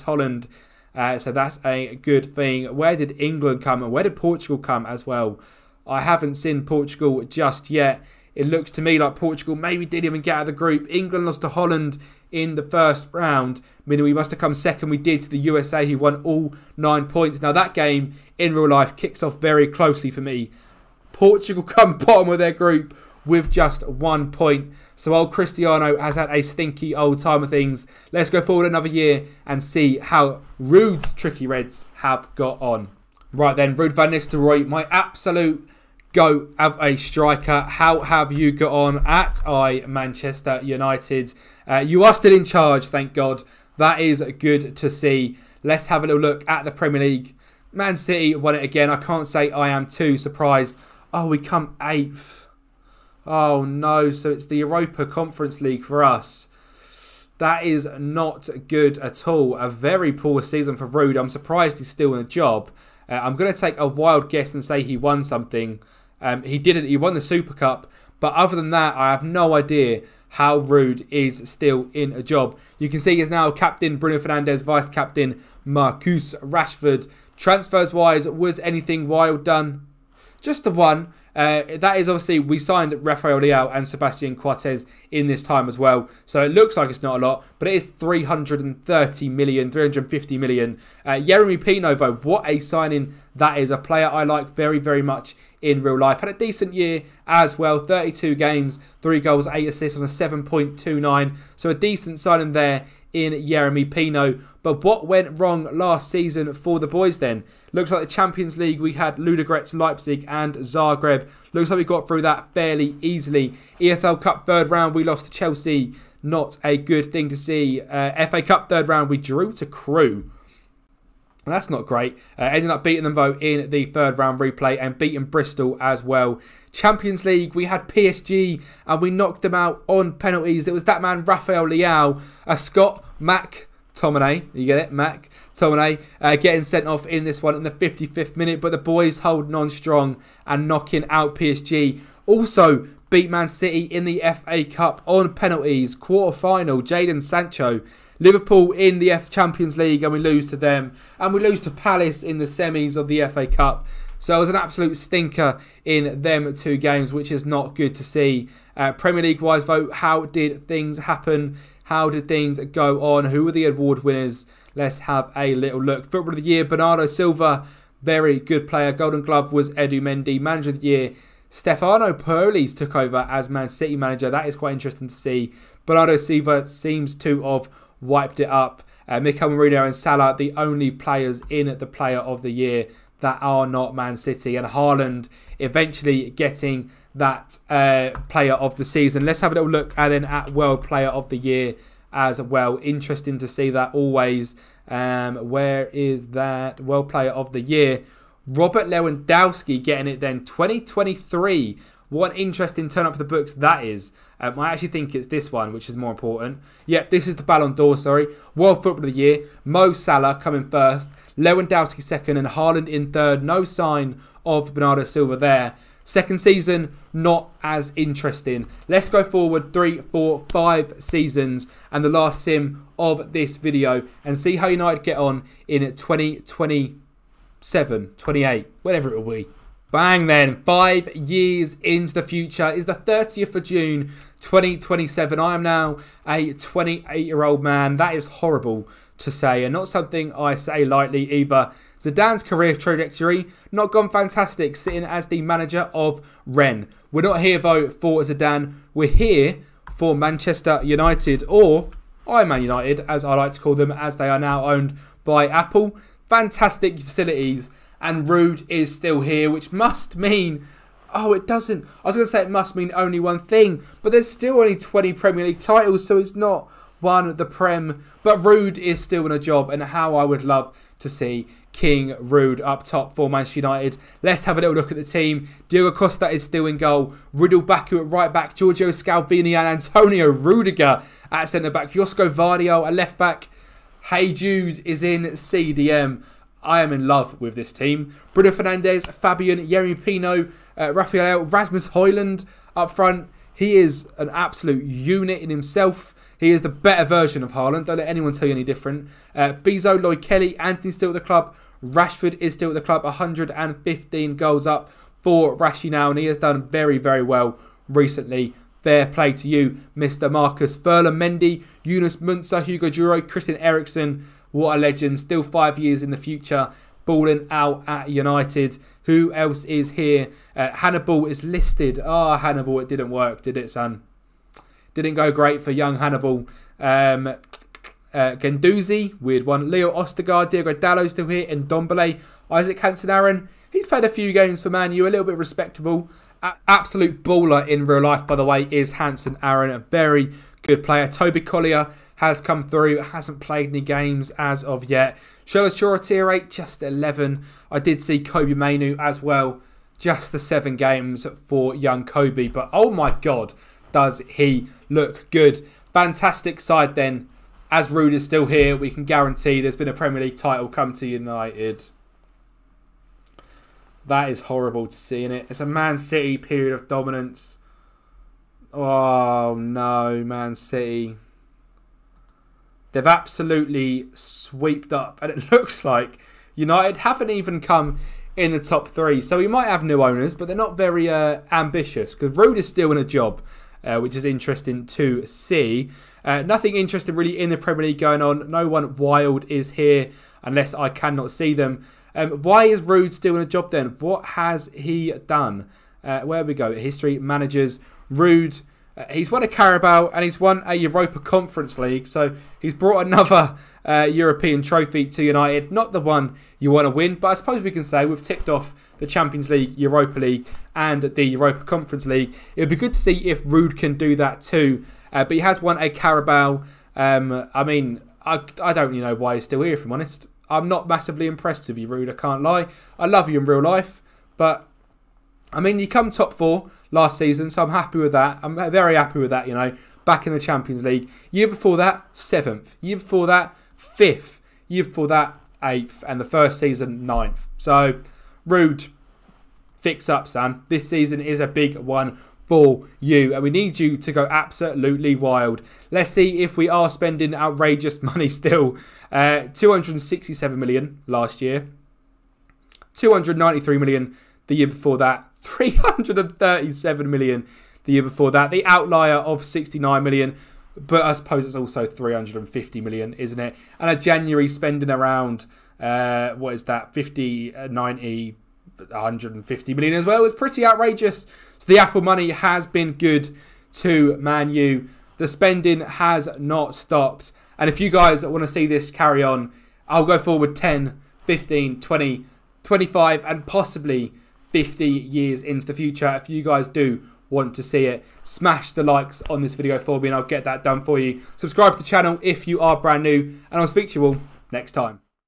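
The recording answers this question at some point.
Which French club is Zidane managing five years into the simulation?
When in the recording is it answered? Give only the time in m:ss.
4:06.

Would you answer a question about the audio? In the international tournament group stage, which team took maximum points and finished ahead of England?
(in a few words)
USA.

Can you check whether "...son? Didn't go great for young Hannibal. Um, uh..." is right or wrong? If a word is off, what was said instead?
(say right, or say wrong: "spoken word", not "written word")
right.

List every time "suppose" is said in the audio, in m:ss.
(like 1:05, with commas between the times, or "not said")
6:47, 7:41.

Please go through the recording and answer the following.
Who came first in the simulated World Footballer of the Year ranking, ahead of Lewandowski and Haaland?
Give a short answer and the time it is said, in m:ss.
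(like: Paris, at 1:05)
Mo Salah, at 3:29.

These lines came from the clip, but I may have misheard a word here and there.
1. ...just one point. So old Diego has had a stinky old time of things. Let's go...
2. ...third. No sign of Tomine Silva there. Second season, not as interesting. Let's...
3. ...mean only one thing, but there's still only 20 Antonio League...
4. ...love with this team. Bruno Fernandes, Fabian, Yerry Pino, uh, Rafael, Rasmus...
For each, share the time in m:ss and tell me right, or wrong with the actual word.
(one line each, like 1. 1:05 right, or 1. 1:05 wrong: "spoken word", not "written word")
1. 0:23 wrong: "Cristiano", not "Diego"
2. 3:33 wrong: "Bernardo", not "Tomine"
3. 4:22 wrong: "Premier", not "Antonio"
4. 4:47 right.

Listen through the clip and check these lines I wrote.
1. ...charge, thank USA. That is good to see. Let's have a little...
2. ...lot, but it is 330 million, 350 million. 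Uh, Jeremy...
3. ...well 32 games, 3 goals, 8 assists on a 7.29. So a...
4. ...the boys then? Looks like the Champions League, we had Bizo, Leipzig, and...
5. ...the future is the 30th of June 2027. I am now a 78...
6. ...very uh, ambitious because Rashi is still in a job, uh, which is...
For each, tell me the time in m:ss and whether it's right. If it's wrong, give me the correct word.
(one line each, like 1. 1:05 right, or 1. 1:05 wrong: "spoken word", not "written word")
1. 0:42 wrong: "God", not "USA"
2. 1:27 right
3. 1:37 right
4. 1:46 wrong: "Ludogorets", not "Bizo"
5. 3:52 wrong: "28", not "78"
6. 6:20 wrong: "Ruud", not "Rashi".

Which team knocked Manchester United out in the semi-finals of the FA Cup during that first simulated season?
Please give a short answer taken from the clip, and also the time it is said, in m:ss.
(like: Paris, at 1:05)
Palace, at 2:31.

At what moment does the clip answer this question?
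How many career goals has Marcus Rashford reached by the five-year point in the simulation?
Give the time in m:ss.
5:03.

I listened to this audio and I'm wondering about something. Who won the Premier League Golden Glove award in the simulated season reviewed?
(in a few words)
Edu Mendy.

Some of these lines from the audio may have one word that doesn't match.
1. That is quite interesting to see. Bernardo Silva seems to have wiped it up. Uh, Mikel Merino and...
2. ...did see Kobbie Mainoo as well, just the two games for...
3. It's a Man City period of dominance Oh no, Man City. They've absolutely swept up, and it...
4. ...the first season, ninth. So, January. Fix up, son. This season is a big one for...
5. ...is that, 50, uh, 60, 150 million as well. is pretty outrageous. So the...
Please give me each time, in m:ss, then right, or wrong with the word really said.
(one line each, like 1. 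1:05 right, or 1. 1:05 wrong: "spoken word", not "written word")
1. 2:54 right
2. 5:47 wrong: "seven", not "two"
3. 6:05 right
4. 7:16 wrong: "Ruud", not "January"
5. 7:46 wrong: "90", not "60".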